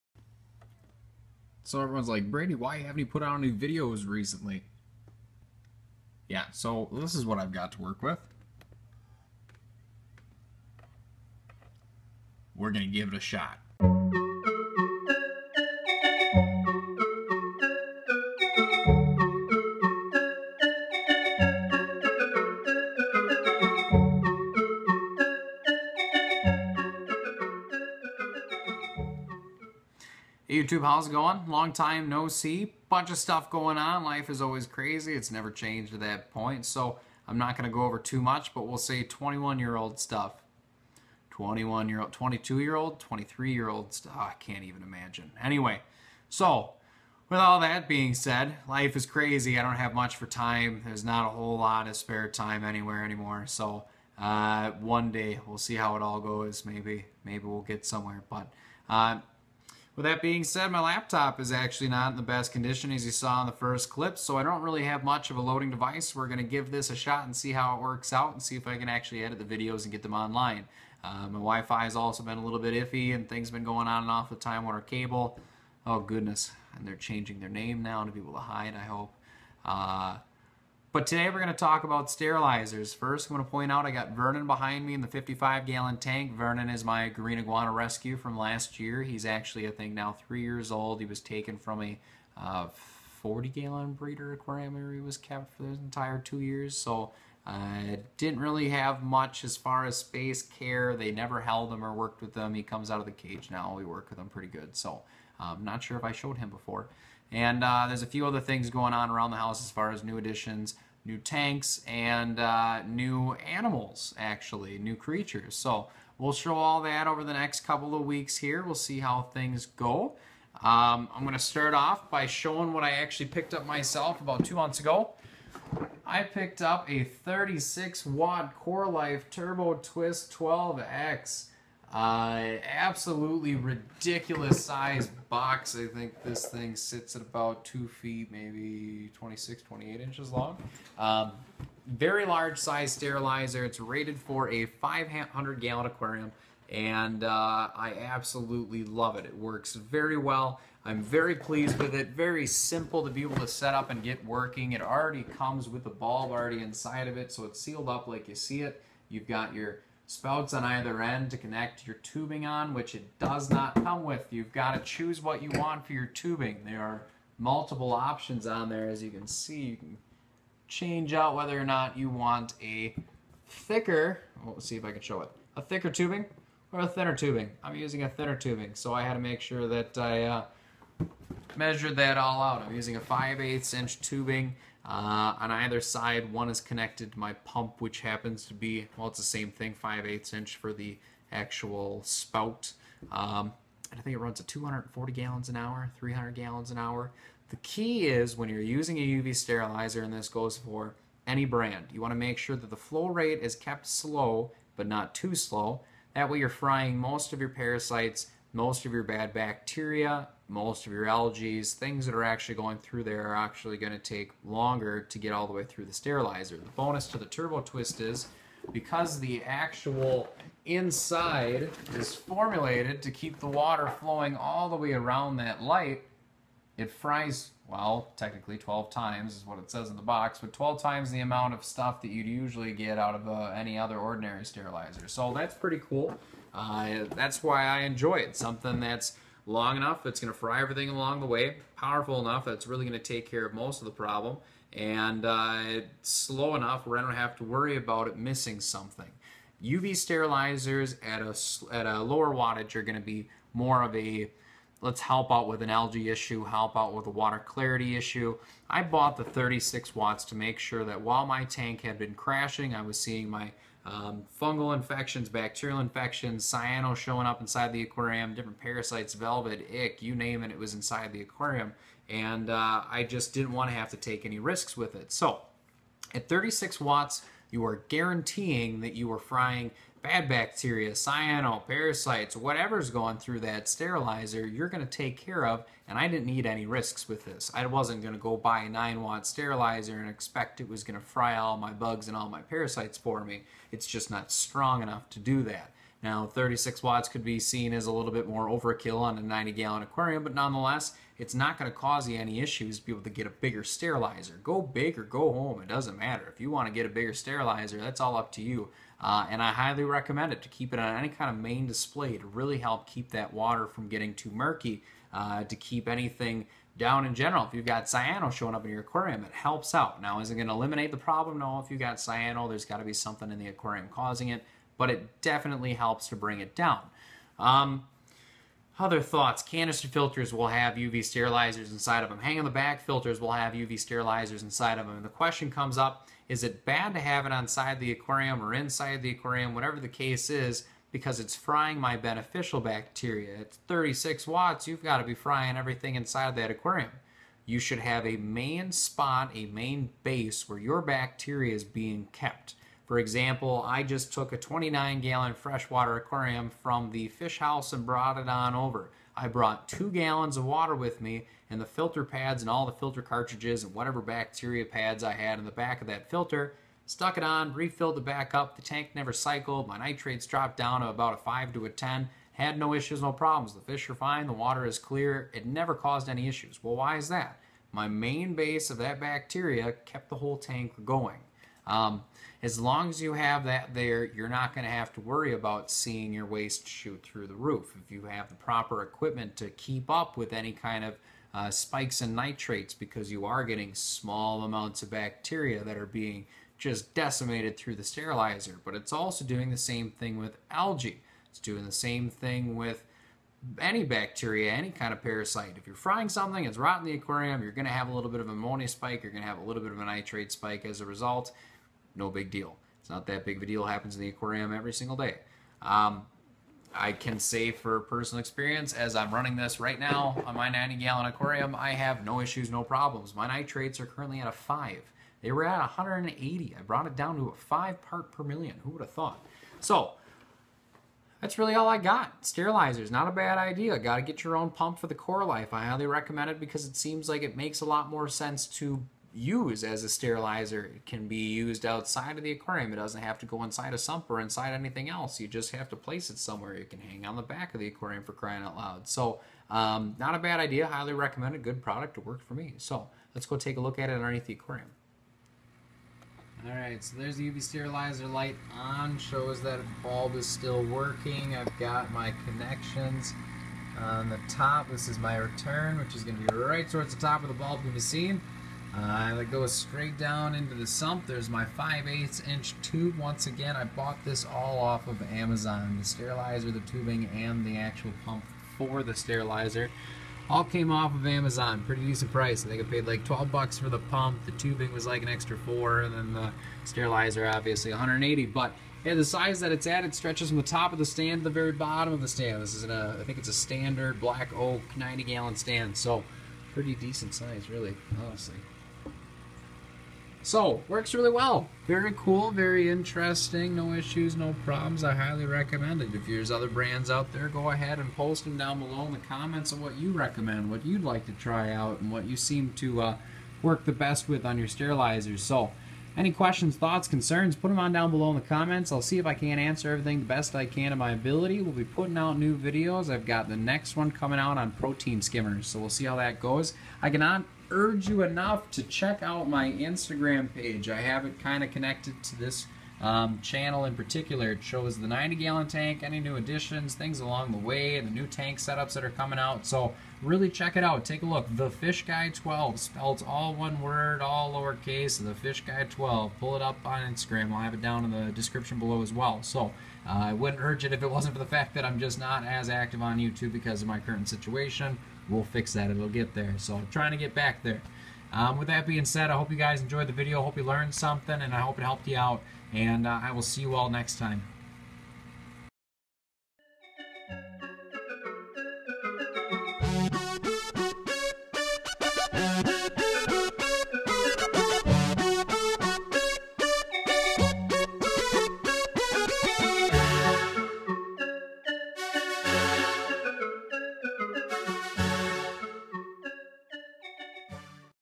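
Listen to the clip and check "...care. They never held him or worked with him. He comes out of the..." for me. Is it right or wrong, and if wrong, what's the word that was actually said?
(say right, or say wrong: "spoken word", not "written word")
right.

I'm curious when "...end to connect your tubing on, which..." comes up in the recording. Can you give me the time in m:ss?
2:41.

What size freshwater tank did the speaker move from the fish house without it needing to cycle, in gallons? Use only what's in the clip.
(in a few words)
29.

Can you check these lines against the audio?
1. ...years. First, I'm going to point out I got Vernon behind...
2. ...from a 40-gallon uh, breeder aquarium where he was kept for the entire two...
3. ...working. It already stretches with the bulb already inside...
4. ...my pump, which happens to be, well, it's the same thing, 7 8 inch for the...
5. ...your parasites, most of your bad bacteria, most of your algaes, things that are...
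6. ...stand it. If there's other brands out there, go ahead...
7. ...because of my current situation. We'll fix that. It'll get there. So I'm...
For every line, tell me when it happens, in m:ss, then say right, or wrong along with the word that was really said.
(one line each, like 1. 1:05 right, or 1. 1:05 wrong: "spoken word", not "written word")
1. 1:22 wrong: "sterilizers", not "years"
2. 1:31 right
3. 2:34 wrong: "comes", not "stretches"
4. 3:07 wrong: "5", not "7"
5. 3:27 right
6. 8:25 wrong: "recommend", not "stand"
7. 9:13 right.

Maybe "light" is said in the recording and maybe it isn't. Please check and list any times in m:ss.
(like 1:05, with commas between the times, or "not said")
3:45, 7:38.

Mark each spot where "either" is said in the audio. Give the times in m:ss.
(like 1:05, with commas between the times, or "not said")
2:40, 3:05.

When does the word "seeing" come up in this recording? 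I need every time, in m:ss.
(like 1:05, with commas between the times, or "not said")
4:22, 6:25.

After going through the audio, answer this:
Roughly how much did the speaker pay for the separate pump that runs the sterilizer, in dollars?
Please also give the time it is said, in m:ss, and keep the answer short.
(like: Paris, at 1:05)
12, at 8:03.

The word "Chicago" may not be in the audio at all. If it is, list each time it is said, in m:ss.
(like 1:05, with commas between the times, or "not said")
not said.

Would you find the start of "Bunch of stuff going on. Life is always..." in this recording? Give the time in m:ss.
0:32.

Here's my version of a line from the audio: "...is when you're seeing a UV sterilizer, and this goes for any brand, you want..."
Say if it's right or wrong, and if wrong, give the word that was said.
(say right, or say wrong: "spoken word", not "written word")
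wrong: "using", not "seeing".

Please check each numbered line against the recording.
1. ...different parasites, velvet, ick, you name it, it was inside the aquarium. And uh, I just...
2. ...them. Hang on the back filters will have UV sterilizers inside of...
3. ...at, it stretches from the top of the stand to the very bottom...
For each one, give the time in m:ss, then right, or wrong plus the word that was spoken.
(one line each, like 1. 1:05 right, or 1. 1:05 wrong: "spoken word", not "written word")
1. 4:28 right
2. 5:32 right
3. 8:09 right.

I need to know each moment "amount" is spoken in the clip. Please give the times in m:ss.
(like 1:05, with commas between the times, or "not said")
3:51, 6:34.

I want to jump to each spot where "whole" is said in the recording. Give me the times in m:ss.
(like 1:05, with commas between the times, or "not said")
0:51, 6:20.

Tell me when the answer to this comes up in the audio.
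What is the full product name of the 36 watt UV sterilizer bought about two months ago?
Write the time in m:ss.
2:08.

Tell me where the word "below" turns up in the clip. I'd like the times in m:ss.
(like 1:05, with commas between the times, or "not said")
8:28, 8:37, 9:08.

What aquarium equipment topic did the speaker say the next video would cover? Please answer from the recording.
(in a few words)
Protein skimmers.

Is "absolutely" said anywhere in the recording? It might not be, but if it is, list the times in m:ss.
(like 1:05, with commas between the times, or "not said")
2:12, 2:28.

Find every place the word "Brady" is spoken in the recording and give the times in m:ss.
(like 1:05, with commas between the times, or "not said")
0:02.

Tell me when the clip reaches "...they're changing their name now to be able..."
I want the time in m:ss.
1:16.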